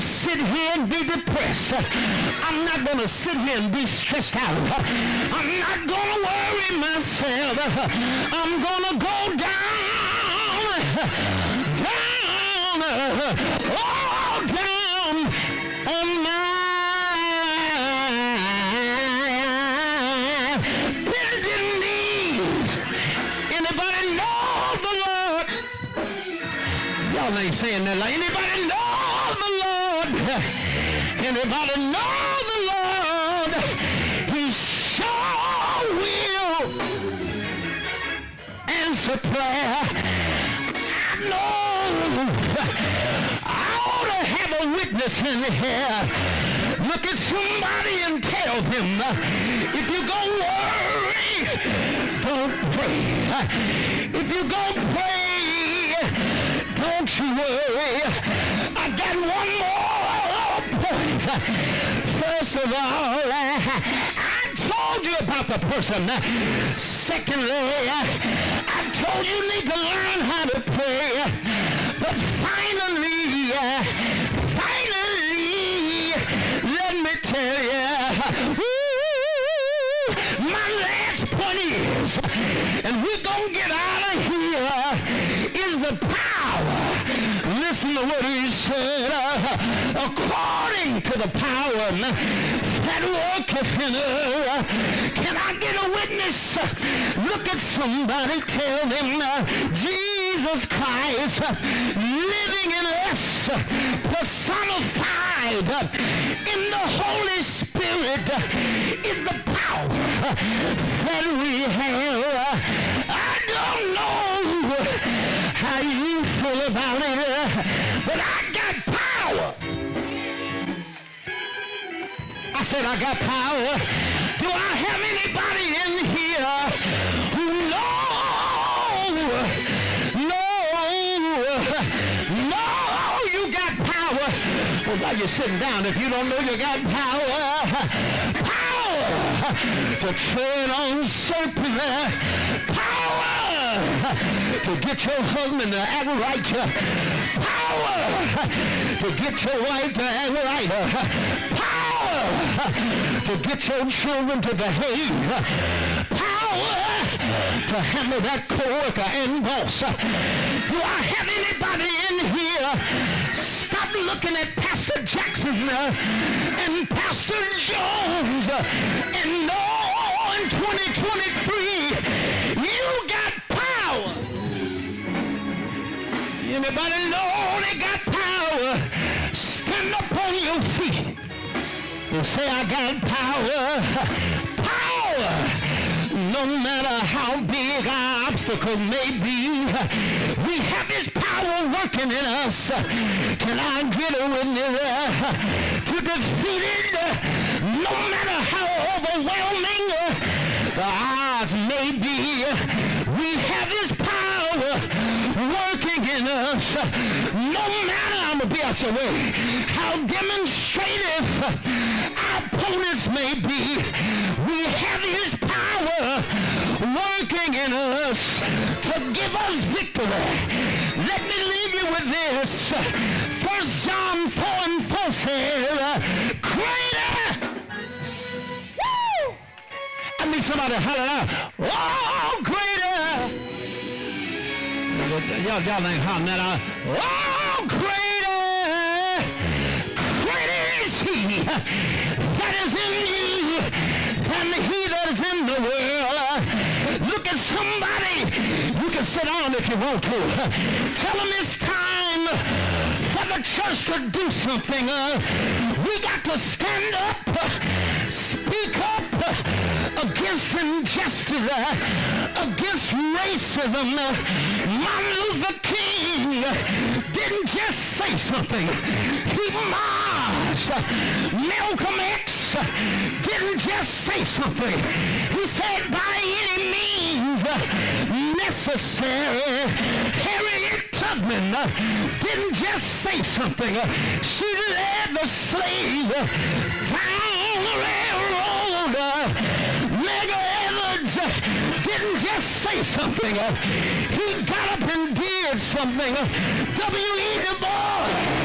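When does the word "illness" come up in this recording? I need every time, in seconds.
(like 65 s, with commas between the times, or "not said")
212 s.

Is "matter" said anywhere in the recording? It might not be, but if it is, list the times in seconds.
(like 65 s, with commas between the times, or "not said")
186 s, 197 s, 207 s.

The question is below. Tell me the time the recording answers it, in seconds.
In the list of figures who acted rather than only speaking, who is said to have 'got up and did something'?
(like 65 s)
289 s.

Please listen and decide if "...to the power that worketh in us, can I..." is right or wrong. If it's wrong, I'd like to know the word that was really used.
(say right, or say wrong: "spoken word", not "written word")
right.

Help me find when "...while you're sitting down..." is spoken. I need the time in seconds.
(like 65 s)
135 s.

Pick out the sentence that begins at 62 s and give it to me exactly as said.
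First of all, I told you about the person.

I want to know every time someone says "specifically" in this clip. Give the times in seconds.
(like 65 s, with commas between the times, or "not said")
not said.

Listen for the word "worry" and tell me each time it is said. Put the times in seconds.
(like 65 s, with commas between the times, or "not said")
6 s, 50 s, 57 s.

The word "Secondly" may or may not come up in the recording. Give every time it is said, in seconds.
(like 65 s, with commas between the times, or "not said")
66 s.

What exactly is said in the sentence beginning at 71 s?
But finally, finally, let me tell you, my last point is, and we're going to get out of here, is the power.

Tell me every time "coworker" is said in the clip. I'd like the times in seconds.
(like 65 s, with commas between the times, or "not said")
158 s.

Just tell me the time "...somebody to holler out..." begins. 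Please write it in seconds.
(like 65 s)
230 s.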